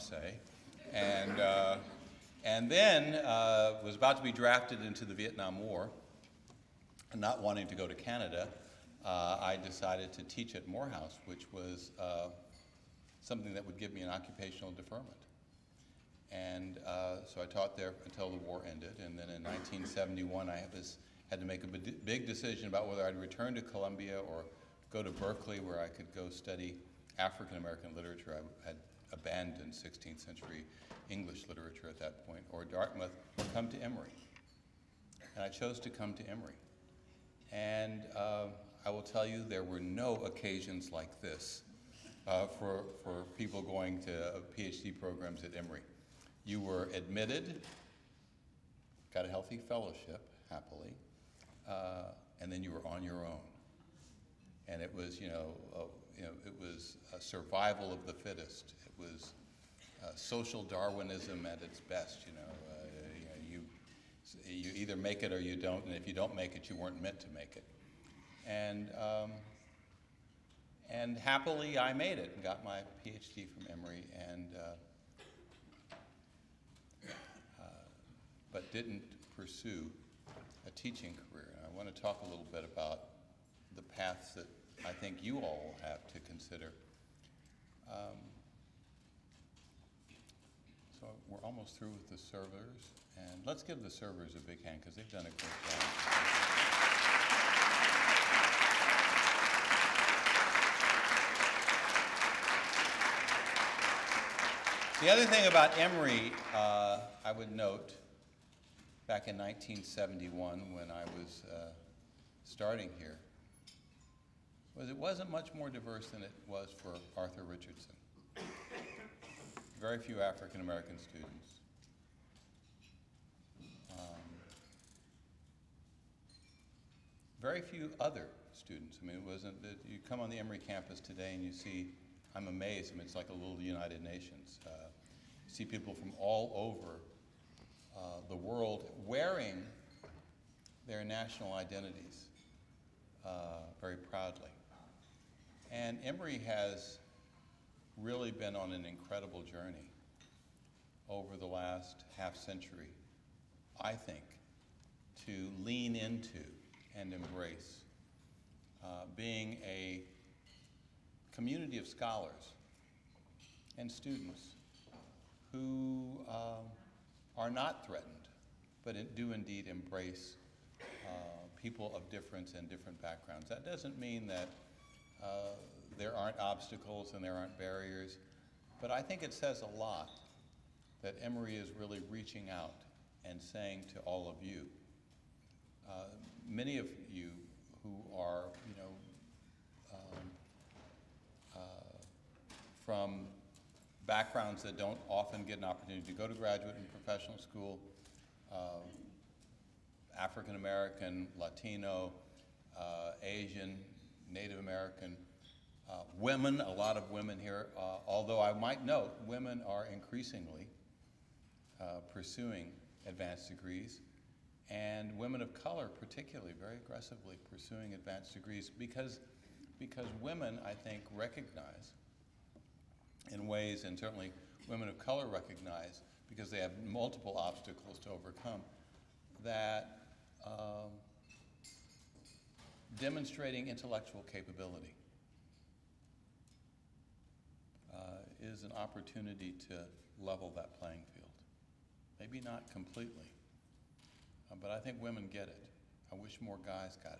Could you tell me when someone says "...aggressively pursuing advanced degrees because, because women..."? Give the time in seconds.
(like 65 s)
216 s.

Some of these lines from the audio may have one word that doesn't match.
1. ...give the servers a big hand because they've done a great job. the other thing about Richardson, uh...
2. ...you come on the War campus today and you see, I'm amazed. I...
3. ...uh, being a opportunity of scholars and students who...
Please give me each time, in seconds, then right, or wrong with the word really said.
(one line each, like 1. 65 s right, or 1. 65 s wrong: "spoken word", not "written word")
1. 93 s wrong: "Emory", not "Richardson"
2. 129 s wrong: "Emory", not "War"
3. 158 s wrong: "community", not "opportunity".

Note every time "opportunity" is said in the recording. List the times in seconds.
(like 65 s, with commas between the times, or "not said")
195 s, 238 s.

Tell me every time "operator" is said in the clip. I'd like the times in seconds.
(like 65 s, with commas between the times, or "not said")
not said.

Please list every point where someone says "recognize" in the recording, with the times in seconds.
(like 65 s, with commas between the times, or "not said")
221 s, 225 s.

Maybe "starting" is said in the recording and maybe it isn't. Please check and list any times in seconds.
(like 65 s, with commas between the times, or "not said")
112 s.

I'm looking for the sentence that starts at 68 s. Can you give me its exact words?
And um, and happily, I made it and got my PhD from Emory, and uh, uh, but didn't pursue a teaching career.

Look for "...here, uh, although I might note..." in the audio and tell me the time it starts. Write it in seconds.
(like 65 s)
207 s.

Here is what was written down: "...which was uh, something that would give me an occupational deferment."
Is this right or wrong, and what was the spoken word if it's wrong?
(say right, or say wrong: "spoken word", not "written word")
right.